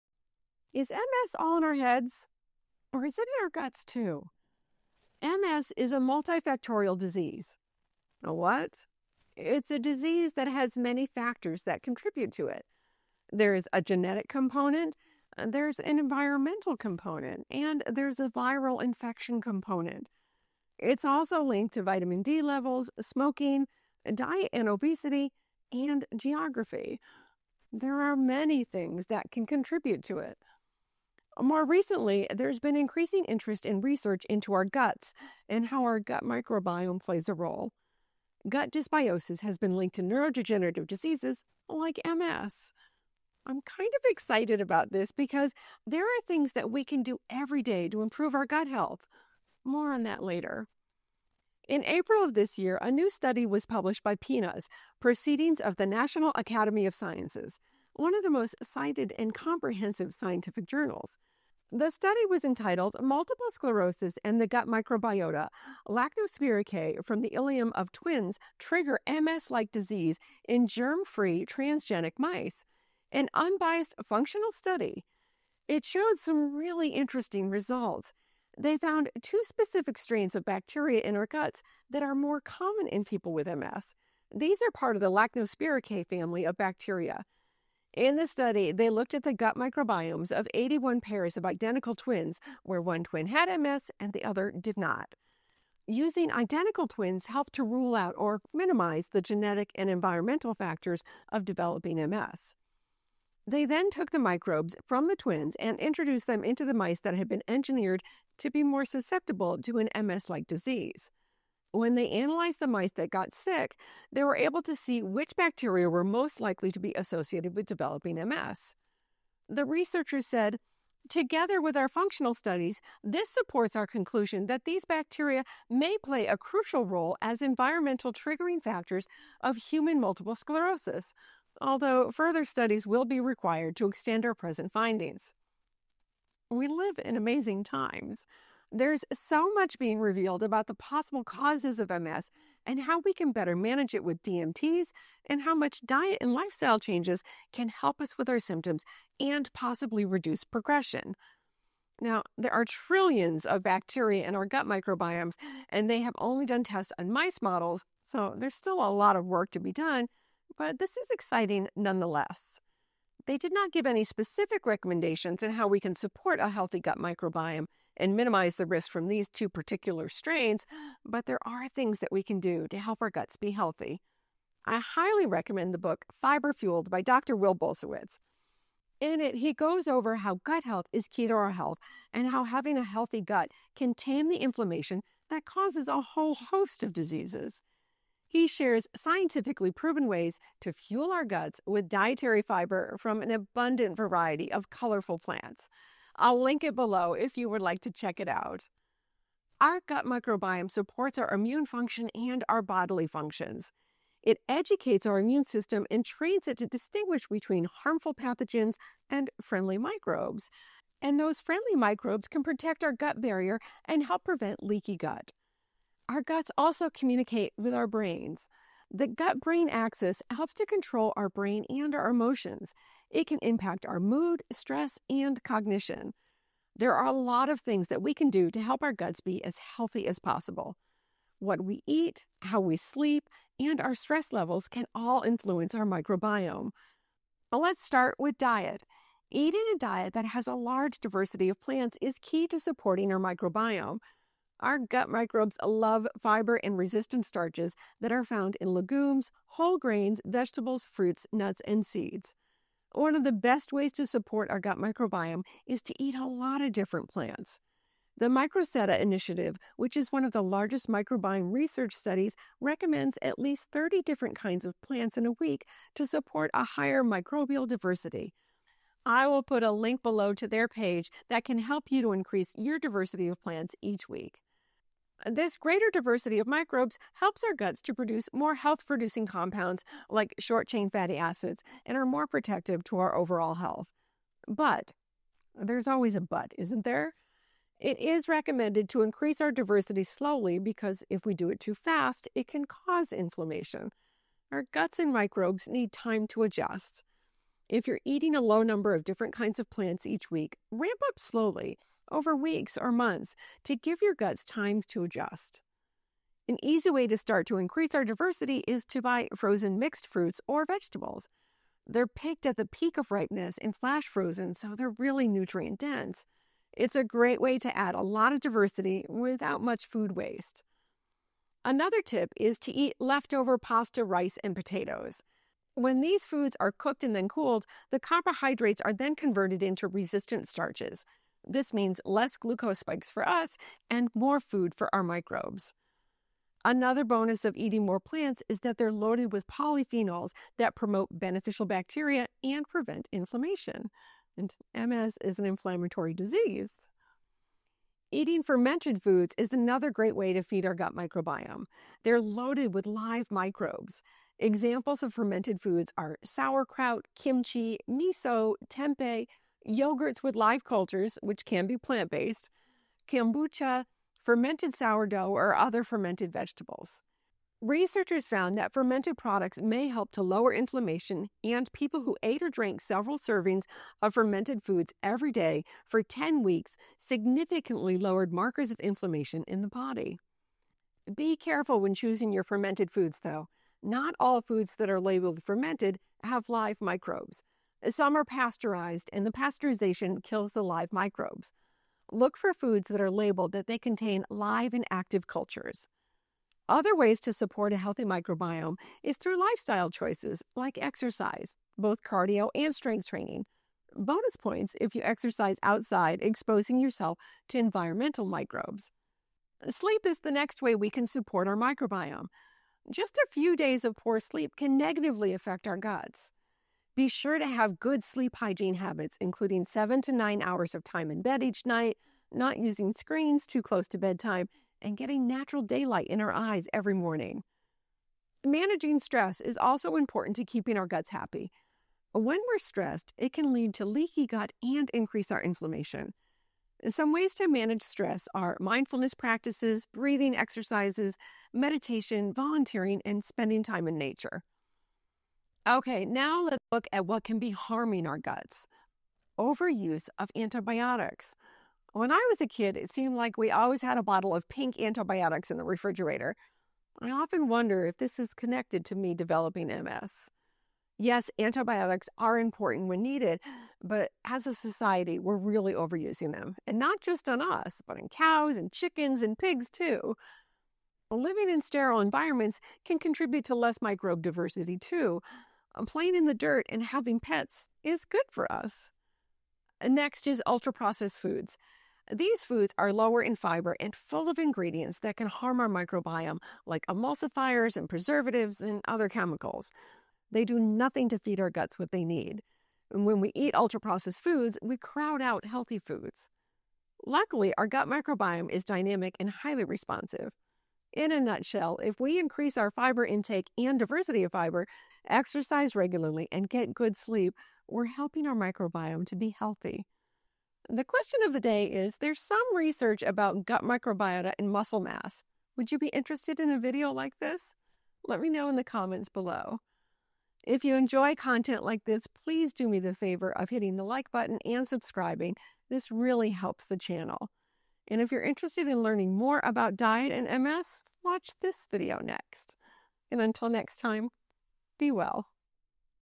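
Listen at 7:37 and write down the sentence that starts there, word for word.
I often wonder if this is connected to me developing MS.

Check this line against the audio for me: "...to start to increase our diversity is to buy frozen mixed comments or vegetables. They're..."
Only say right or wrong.
wrong.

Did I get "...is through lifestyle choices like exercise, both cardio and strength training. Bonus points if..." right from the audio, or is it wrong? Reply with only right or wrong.
right.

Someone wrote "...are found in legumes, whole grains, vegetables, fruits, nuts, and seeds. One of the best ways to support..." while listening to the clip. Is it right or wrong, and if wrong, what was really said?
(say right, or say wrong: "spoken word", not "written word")
right.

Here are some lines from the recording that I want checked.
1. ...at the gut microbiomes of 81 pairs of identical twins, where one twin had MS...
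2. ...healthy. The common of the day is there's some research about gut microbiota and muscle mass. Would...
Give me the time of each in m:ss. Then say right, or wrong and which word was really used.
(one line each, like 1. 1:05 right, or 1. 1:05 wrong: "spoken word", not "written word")
1. 1:29 right
2. 8:29 wrong: "question", not "common".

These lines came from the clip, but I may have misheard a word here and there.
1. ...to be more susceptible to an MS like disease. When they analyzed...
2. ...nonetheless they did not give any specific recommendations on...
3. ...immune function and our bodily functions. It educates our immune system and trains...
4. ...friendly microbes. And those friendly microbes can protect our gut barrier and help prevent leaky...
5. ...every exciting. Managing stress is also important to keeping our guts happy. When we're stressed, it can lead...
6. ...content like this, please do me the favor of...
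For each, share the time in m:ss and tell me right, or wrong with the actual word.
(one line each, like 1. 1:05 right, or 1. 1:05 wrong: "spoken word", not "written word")
1. 1:48 right
2. 2:41 right
3. 3:21 right
4. 3:29 right
5. 7:06 wrong: "morning", not "exciting"
6. 8:41 right.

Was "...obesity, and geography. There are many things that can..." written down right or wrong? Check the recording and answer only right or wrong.
right.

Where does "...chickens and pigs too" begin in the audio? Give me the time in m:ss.
7:48.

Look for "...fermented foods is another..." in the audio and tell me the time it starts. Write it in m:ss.
5:48.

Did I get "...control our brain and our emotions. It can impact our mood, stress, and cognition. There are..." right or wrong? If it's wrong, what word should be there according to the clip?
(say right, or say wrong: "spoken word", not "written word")
right.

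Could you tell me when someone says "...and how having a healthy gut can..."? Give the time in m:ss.
3:02.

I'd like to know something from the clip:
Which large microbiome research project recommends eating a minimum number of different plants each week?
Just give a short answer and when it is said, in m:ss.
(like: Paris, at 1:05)
The Microsetta Initiative, at 4:18.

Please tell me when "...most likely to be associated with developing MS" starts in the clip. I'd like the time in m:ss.
1:56.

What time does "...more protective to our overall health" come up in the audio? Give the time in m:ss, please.
4:42.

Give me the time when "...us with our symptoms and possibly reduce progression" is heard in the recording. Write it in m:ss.
2:27.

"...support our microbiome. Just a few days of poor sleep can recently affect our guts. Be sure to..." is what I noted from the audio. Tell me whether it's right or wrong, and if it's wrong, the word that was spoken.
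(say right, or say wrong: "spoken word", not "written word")
wrong: "negatively", not "recently".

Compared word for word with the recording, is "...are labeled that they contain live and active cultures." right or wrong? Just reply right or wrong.
right.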